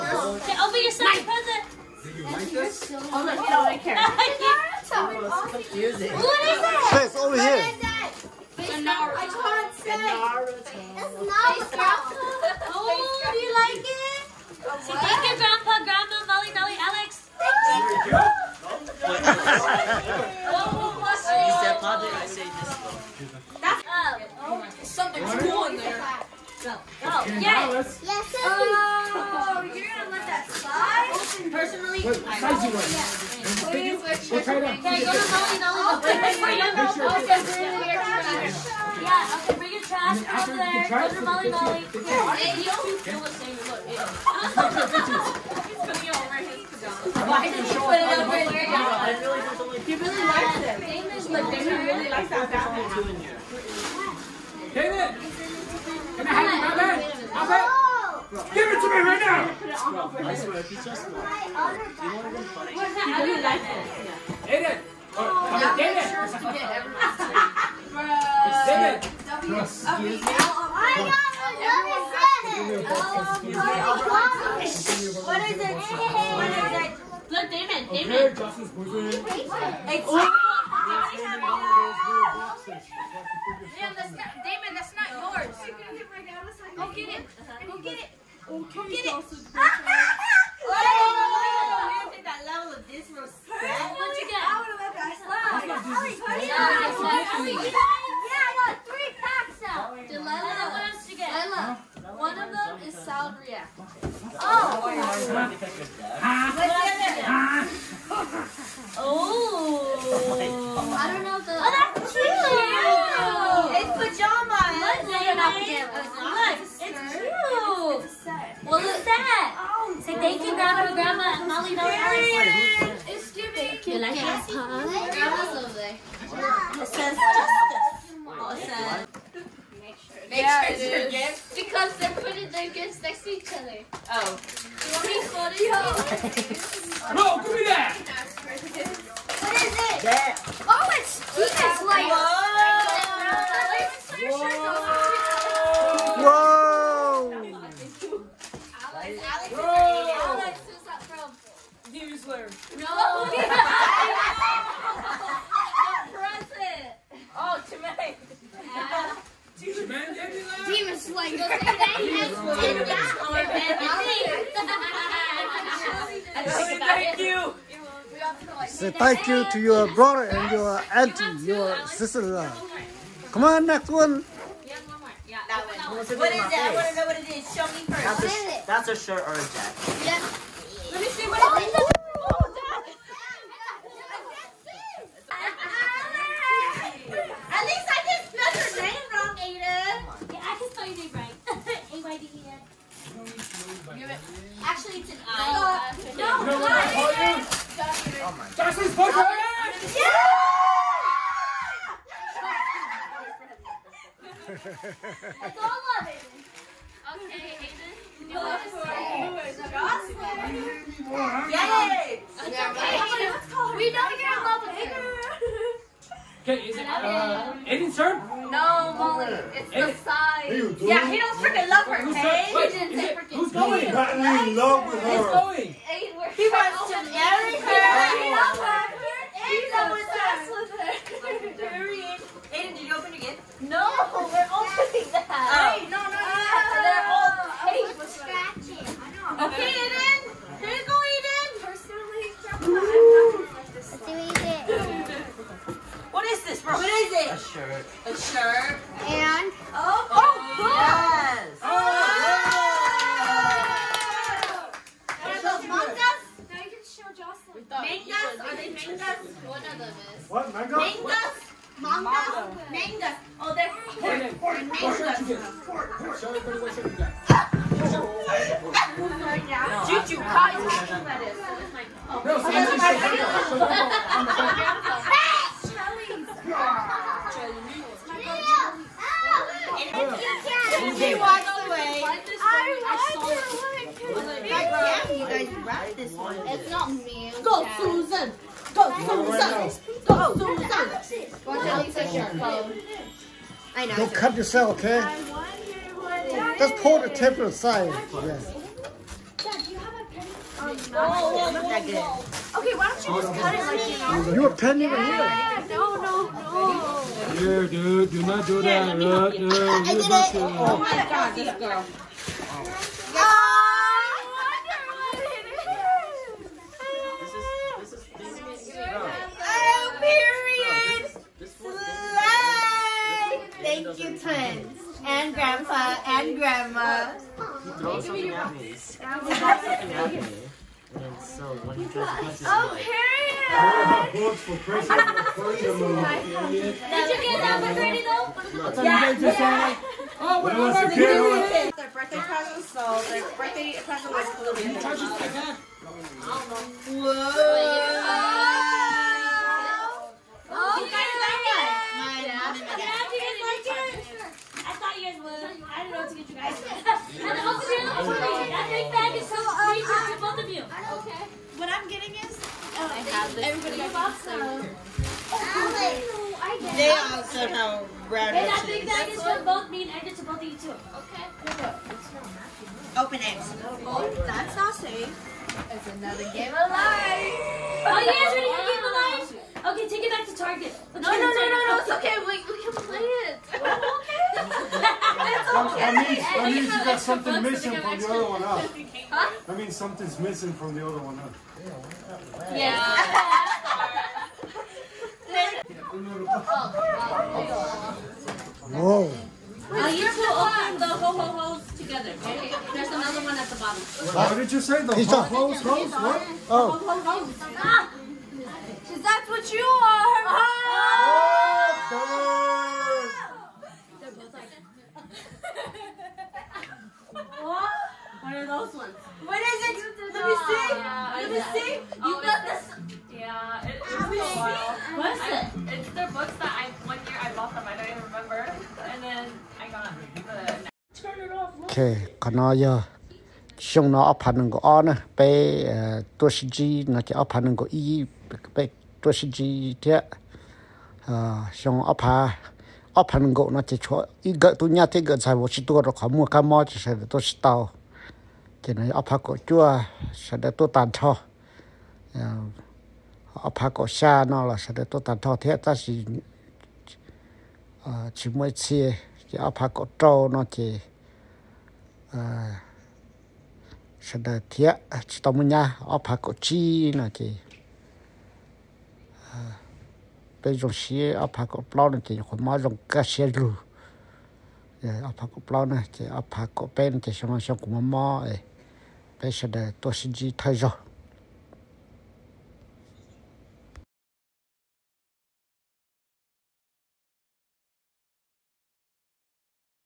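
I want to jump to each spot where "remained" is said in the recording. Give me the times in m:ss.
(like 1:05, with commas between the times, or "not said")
not said.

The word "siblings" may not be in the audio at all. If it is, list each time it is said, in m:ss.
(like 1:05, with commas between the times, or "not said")
not said.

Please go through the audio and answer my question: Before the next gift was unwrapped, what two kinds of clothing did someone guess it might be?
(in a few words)
A shirt or a jacket.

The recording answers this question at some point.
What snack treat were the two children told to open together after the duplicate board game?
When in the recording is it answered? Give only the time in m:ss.
6:40.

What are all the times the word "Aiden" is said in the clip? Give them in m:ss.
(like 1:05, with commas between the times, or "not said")
1:04, 3:37, 3:52, 3:59.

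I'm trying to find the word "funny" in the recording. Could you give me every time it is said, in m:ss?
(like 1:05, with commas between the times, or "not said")
1:02.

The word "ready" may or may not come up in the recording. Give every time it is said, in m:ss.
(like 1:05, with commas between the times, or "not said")
5:37, 6:18.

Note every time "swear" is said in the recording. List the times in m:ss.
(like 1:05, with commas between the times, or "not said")
1:00.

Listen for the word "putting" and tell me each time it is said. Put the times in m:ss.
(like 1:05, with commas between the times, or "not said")
0:45, 2:12.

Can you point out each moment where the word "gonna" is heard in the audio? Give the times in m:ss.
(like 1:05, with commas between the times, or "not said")
0:29.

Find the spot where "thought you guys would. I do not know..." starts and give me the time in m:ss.
5:54.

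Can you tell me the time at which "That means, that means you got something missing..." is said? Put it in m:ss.
6:25.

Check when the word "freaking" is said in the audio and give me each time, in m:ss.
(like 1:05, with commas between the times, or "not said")
3:41.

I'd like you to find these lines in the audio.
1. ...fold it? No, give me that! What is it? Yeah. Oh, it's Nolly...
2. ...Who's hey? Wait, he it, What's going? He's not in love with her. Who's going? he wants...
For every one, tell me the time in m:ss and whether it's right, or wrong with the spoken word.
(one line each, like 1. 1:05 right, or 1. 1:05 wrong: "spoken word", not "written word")
1. 2:15 wrong: "Jesus", not "Nolly"
2. 3:42 wrong: "Who", not "What".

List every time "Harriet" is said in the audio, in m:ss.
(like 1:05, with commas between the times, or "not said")
5:32.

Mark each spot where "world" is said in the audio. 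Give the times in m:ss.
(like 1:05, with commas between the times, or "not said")
not said.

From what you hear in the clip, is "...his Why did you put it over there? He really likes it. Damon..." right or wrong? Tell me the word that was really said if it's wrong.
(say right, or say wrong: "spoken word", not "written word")
right.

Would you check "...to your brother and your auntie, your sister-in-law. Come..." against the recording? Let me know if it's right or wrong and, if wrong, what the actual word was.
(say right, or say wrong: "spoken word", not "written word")
right.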